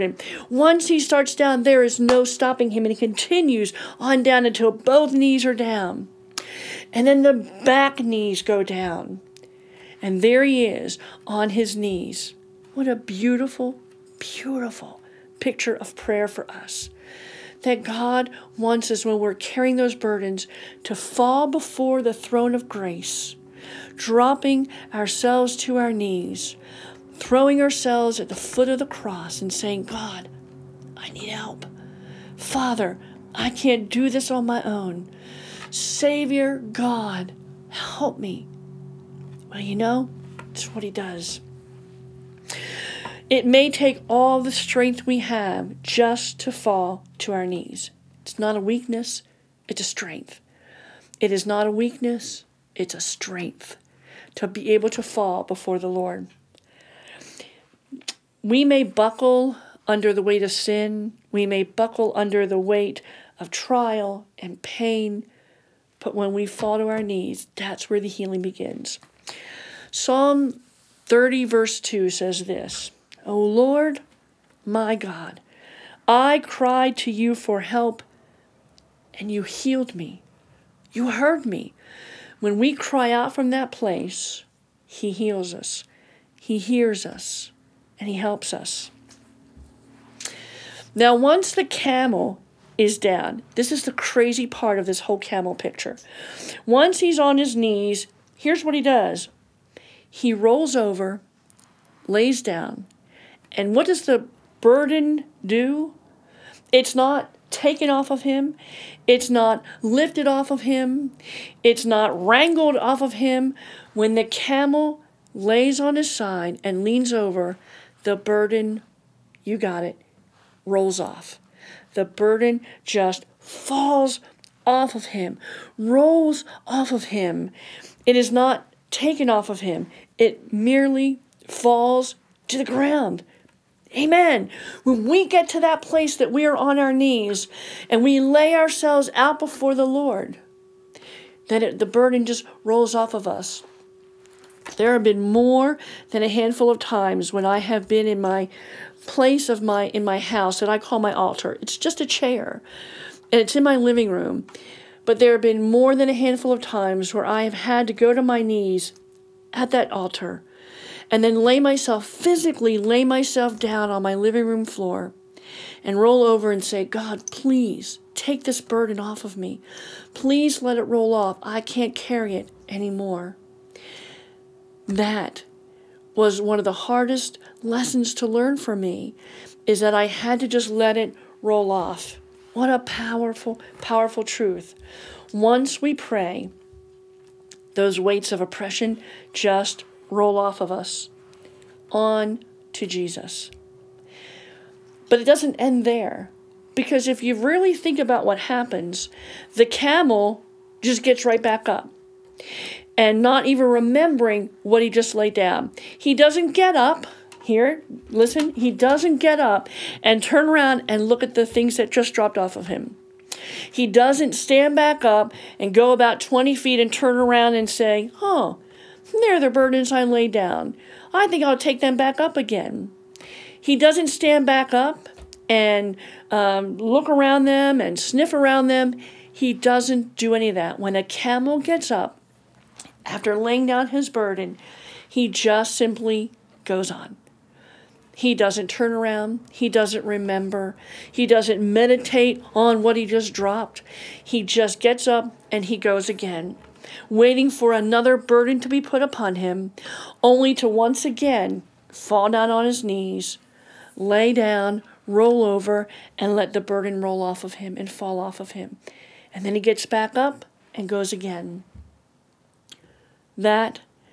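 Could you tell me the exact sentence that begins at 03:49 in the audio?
He doesn't do any of that.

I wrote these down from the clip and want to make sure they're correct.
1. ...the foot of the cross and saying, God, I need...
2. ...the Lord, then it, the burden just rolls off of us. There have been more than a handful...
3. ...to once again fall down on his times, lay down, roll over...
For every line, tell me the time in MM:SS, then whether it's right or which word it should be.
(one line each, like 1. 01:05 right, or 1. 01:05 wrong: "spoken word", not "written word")
1. 00:28 right
2. 02:19 right
3. 04:10 wrong: "knees", not "times".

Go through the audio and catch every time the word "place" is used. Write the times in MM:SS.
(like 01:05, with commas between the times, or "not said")
01:23, 02:15, 02:29.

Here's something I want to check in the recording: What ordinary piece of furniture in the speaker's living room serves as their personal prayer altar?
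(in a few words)
A chair.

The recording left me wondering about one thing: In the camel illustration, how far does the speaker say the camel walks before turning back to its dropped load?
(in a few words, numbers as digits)
20 feet.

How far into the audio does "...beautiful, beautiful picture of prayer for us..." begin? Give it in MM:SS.
00:12.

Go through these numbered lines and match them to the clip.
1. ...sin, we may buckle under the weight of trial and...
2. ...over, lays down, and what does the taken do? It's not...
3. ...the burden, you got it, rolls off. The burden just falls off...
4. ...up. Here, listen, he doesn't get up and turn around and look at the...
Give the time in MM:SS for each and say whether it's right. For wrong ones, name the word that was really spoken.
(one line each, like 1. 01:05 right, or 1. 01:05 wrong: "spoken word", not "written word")
1. 01:00 right
2. 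01:40 wrong: "burden", not "taken"
3. 01:58 right
4. 03:26 right.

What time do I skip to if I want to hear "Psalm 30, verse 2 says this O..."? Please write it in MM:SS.
01:09.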